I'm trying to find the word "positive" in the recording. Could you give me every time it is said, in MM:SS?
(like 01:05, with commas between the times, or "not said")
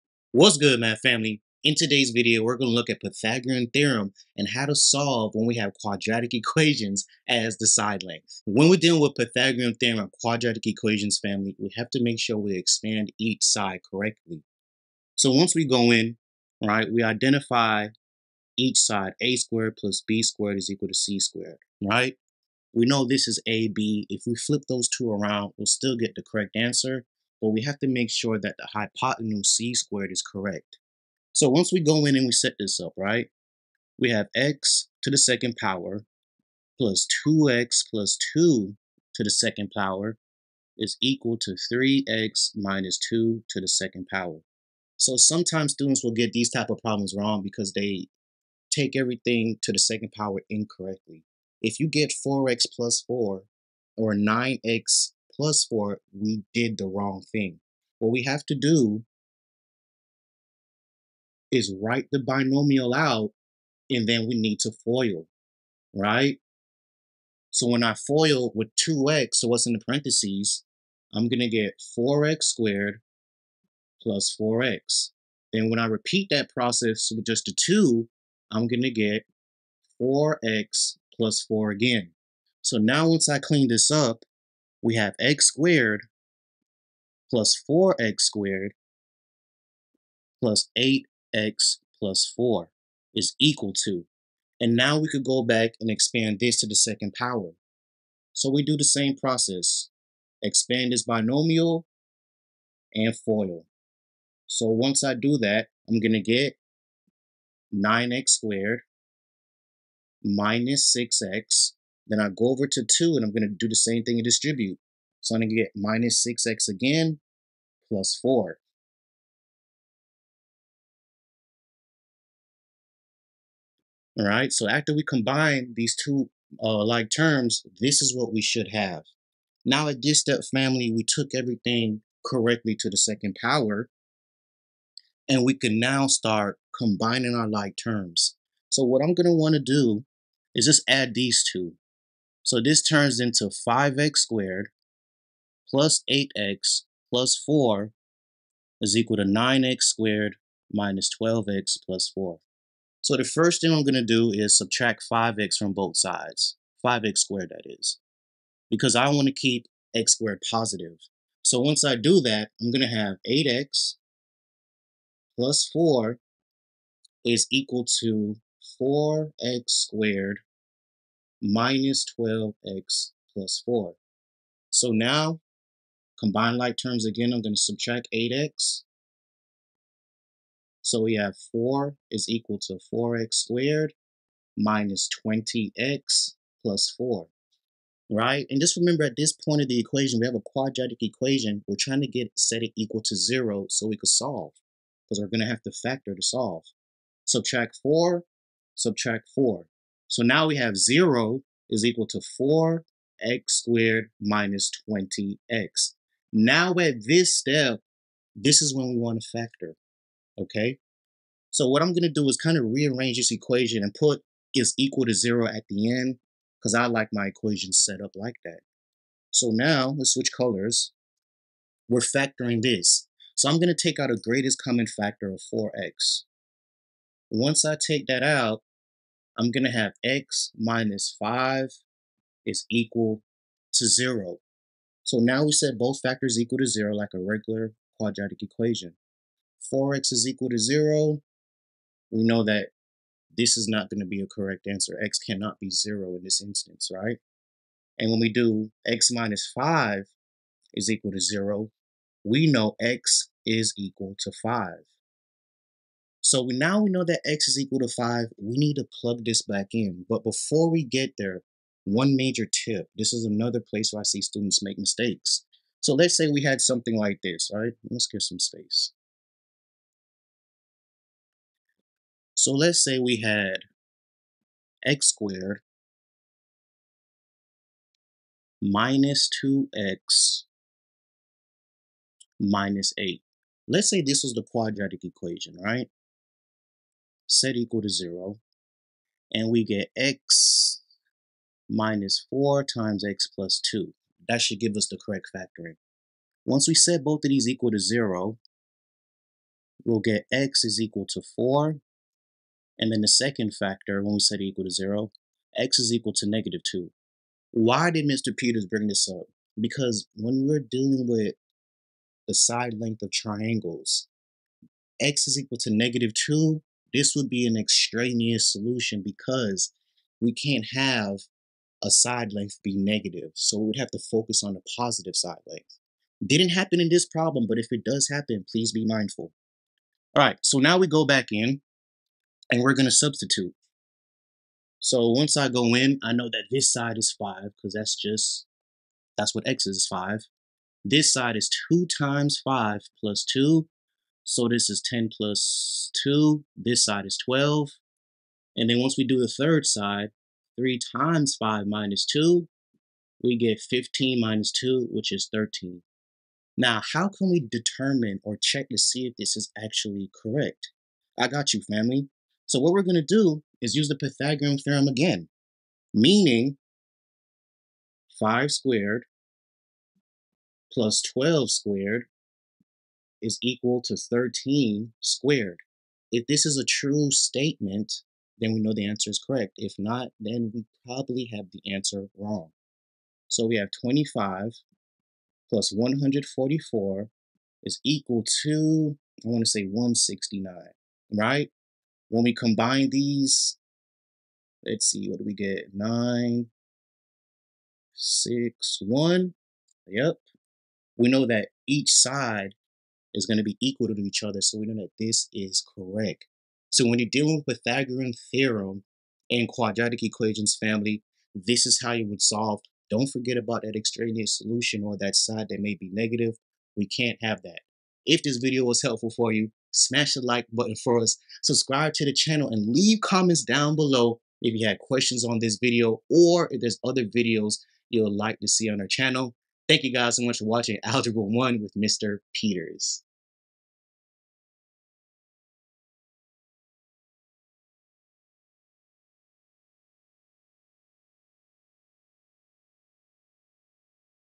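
02:40, 05:24.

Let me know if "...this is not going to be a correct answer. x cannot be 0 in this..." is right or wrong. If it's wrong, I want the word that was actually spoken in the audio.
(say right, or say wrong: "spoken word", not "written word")
right.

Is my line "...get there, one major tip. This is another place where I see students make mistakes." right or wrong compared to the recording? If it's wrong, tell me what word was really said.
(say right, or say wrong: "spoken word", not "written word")
right.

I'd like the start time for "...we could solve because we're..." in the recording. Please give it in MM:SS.
03:13.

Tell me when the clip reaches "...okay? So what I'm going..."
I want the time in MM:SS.
03:30.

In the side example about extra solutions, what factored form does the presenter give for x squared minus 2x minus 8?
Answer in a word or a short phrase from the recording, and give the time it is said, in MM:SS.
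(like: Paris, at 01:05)
x minus 4 times x plus 2, at 04:49.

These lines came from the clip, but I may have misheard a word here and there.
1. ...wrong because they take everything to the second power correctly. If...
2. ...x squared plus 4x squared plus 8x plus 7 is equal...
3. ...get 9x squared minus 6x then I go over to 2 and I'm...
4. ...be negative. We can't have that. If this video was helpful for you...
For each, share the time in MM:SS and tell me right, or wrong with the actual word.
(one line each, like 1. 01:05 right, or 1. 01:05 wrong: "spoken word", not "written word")
1. 00:47 wrong: "incorrectly", not "correctly"
2. 01:25 wrong: "4", not "7"
3. 01:46 right
4. 06:55 right.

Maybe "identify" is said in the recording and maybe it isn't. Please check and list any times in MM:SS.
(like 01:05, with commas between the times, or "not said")
00:17.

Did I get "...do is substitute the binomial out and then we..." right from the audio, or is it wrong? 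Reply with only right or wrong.
wrong.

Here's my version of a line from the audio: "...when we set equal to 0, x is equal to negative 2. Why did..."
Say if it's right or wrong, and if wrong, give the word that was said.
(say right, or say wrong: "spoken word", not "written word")
right.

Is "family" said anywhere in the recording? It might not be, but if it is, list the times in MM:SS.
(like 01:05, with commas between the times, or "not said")
00:01, 00:11, 02:10, 06:01, 06:50.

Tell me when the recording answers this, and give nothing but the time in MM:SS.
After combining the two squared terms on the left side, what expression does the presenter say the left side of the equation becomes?
02:23.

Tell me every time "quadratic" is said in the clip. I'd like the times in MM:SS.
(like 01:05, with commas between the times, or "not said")
00:05, 00:10, 03:10, 03:57, 04:44, 06:49.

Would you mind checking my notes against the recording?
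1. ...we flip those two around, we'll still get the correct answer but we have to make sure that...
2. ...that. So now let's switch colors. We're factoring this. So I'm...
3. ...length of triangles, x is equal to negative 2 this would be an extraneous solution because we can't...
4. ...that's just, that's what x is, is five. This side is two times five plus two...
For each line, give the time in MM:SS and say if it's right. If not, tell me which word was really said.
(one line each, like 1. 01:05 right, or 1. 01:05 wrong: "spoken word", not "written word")
1. 00:24 right
2. 03:38 right
3. 05:12 right
4. 05:37 right.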